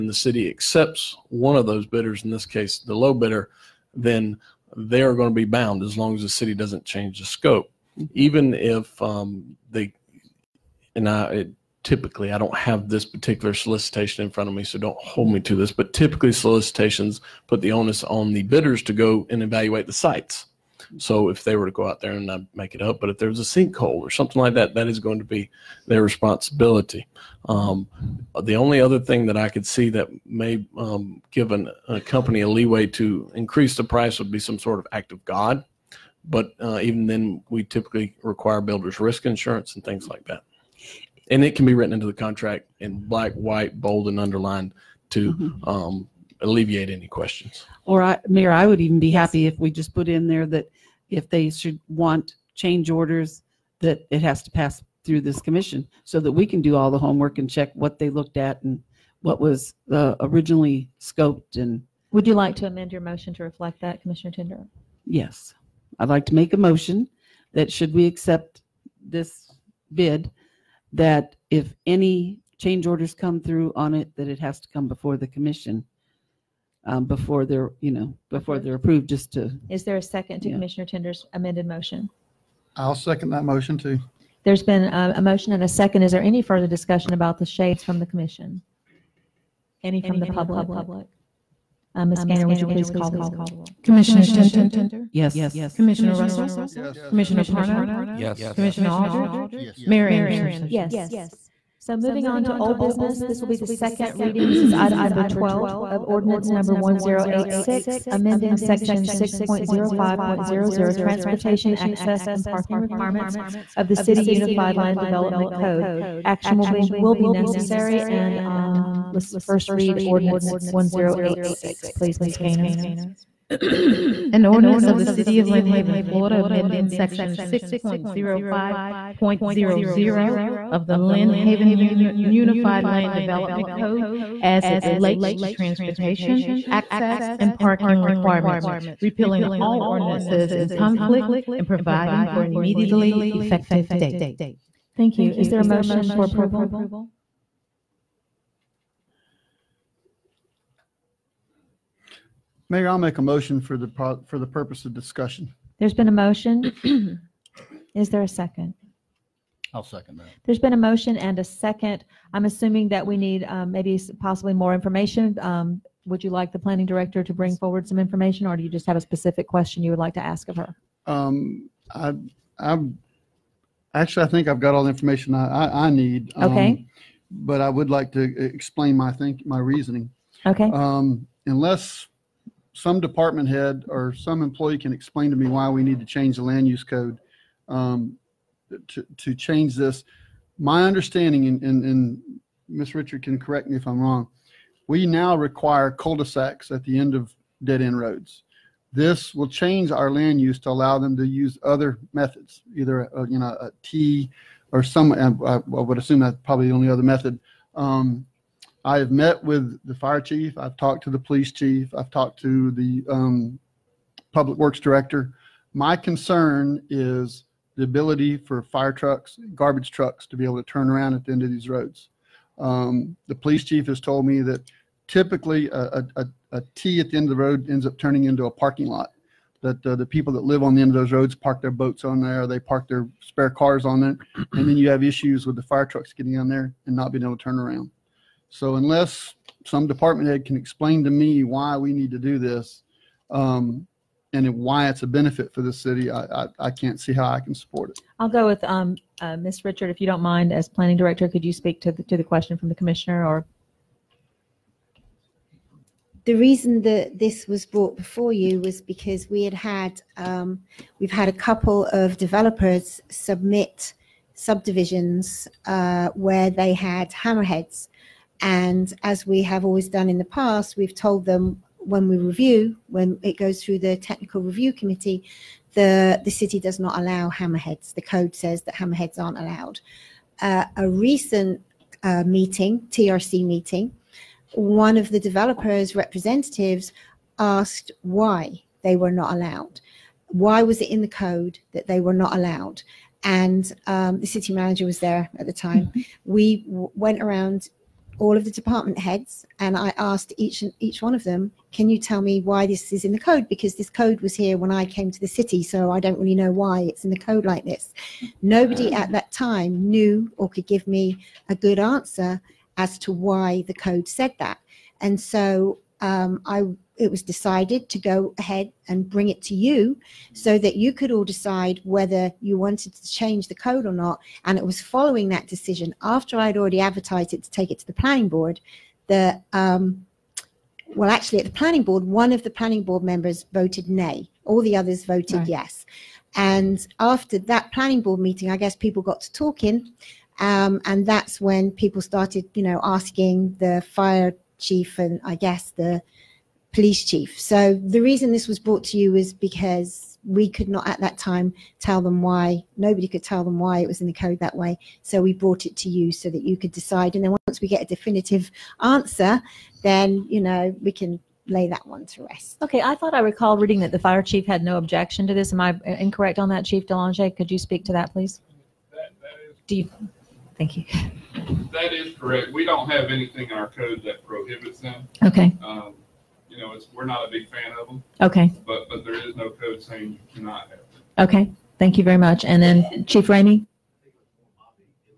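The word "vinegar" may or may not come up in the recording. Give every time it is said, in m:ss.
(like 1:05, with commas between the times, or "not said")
not said.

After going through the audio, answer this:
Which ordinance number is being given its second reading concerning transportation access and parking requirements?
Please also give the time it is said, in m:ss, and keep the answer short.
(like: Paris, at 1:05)
1086, at 1:46.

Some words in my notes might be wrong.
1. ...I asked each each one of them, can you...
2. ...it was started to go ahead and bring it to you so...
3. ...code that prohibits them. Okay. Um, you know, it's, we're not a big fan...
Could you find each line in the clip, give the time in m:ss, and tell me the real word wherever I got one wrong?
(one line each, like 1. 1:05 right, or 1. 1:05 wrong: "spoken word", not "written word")
1. 4:59 right
2. 5:16 wrong: "decided", not "started"
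3. 6:13 right.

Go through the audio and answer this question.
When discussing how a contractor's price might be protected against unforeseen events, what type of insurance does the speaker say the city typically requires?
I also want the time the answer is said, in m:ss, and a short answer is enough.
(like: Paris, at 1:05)
builders risk insurance, at 0:38.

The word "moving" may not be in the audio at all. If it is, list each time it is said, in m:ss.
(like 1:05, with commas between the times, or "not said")
1:41.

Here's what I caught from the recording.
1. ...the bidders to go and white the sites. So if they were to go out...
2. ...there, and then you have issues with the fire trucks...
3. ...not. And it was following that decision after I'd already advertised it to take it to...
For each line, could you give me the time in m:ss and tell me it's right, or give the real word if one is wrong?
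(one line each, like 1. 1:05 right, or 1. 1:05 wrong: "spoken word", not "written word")
1. 0:18 wrong: "evaluate", not "white"
2. 3:54 right
3. 5:23 right.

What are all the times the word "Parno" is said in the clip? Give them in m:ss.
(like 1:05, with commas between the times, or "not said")
1:37.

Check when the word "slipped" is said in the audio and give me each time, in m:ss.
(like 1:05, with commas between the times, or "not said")
not said.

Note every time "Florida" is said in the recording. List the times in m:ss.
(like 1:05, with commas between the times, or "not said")
2:05.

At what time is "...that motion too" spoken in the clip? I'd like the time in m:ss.
1:23.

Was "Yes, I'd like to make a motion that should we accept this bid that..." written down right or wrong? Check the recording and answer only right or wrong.
right.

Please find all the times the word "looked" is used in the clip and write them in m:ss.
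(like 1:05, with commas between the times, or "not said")
0:58.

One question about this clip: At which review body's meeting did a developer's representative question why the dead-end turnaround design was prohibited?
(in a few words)
technical review committee.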